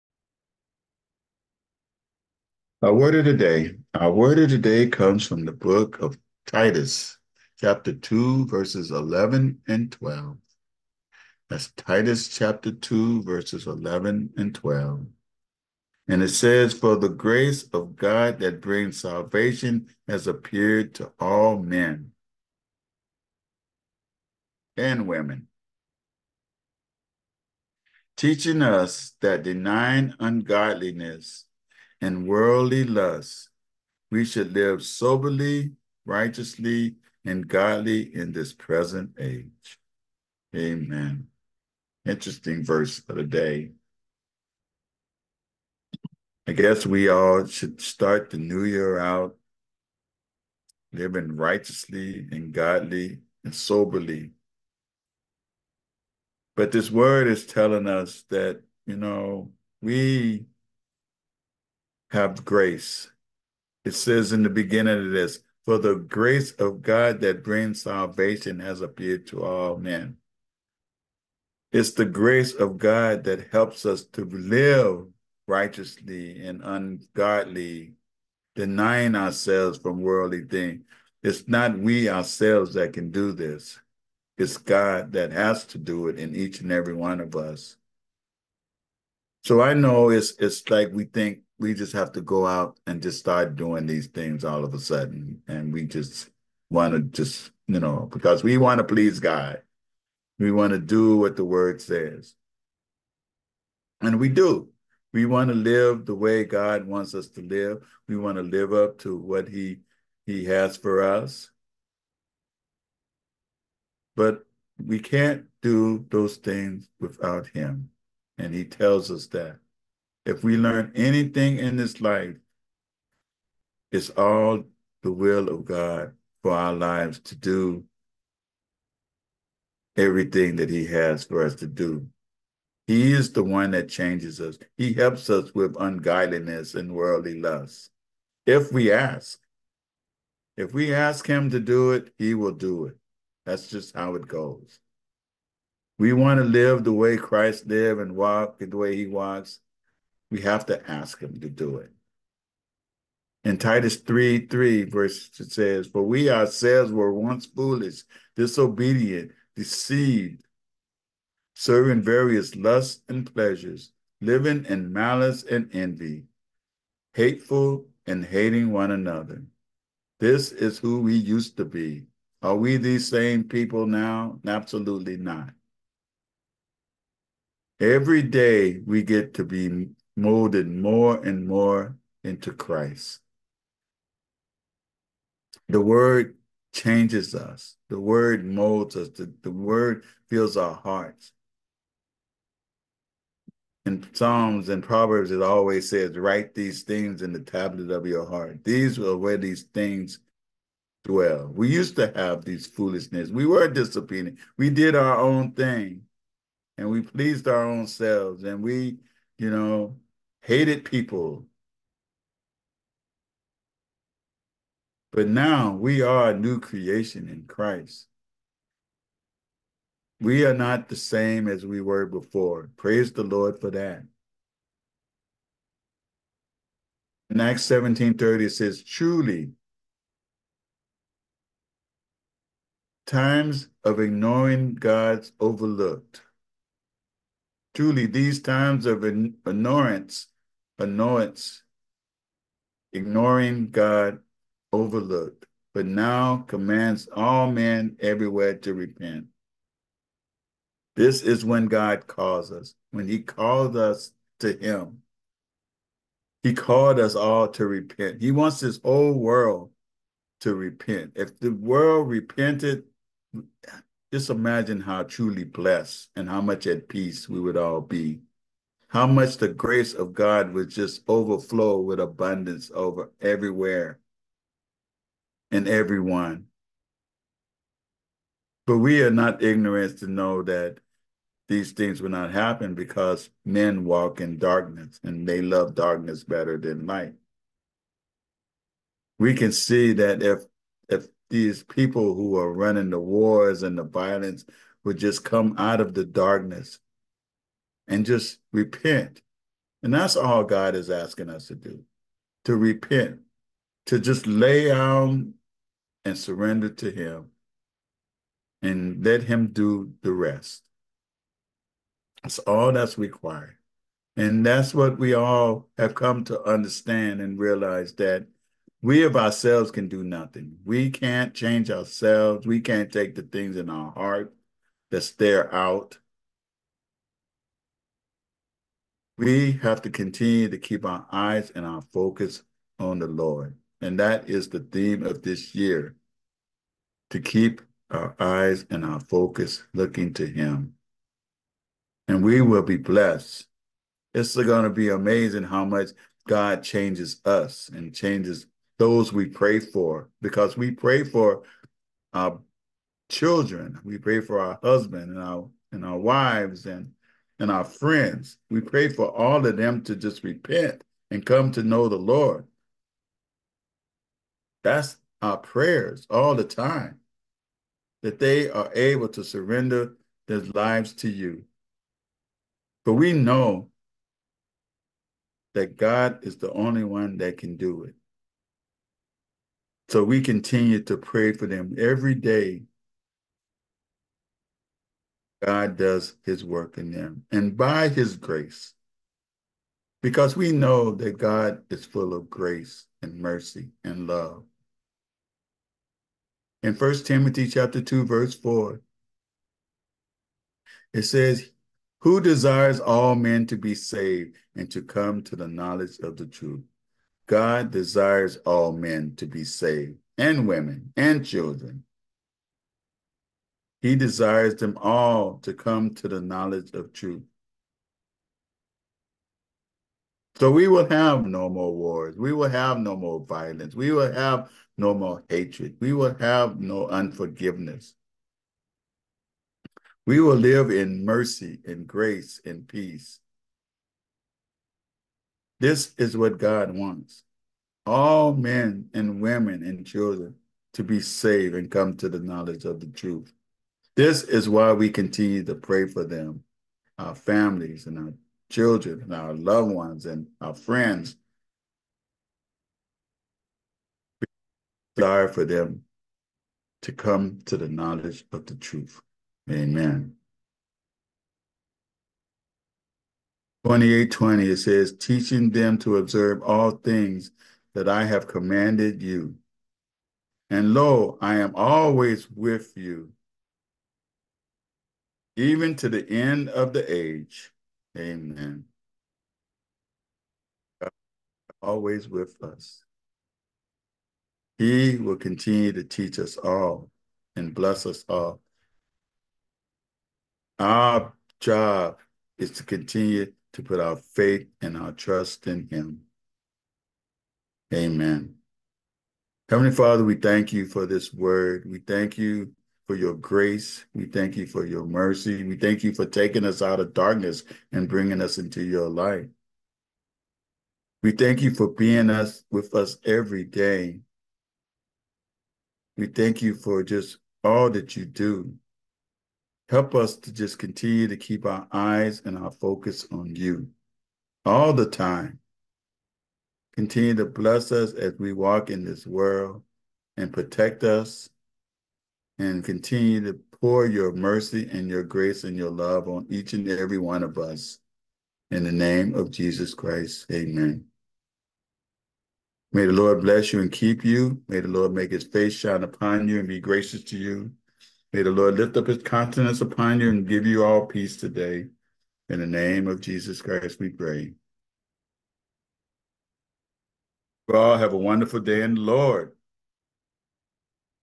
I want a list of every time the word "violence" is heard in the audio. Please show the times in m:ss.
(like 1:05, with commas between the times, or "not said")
4:53, 7:03.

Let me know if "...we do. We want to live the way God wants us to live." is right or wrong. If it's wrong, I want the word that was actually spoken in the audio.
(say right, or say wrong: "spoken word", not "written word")
right.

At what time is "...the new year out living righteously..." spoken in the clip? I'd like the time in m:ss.
0:48.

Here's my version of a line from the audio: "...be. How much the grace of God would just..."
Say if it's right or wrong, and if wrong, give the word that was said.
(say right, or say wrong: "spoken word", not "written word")
right.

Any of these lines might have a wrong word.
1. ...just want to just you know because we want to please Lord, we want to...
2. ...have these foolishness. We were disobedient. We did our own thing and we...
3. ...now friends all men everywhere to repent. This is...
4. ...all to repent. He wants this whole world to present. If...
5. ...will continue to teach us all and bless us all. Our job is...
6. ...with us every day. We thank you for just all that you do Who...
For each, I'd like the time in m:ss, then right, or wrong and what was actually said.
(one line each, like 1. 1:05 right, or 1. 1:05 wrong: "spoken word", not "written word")
1. 1:35 wrong: "God", not "Lord"
2. 3:22 right
3. 4:05 wrong: "commands", not "friends"
4. 4:17 wrong: "repent", not "present"
5. 8:04 right
6. 8:32 wrong: "Help", not "Who".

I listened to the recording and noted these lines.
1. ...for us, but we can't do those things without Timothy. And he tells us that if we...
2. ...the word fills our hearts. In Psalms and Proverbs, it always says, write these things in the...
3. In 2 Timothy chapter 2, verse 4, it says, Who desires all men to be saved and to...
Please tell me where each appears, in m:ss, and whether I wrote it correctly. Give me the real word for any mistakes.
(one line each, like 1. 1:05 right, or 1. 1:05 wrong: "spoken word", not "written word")
1. 1:50 wrong: "Him", not "Timothy"
2. 3:09 right
3. 6:36 wrong: "1", not "2".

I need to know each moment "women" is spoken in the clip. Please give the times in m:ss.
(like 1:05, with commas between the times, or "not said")
0:25, 6:50, 7:19.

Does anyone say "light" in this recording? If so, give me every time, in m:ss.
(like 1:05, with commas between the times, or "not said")
4:46, 8:28.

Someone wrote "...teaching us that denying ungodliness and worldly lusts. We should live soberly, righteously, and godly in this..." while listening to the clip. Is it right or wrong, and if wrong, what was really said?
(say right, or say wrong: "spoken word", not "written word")
right.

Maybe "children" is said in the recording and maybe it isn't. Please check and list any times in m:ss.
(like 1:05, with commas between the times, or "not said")
5:53, 6:51, 7:19, 7:28.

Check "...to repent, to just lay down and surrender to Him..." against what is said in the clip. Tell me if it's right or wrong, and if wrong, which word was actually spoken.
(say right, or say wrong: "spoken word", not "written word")
right.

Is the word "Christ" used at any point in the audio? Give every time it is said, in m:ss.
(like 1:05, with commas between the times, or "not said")
2:27, 3:02, 3:37, 8:59, 9:13.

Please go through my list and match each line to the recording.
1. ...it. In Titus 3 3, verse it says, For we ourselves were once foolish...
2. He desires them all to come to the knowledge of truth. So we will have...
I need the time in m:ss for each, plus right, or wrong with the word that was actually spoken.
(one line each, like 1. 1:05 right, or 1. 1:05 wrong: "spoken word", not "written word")
1. 2:31 right
2. 6:53 right.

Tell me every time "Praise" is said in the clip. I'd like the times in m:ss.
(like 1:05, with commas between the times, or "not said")
3:42.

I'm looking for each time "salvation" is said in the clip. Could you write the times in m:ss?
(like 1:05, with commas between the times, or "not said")
0:19, 1:07.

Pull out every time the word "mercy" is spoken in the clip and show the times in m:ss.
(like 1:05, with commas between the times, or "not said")
6:33, 7:11, 8:24, 8:54.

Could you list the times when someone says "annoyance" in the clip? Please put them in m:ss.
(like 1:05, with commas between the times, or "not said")
4:00.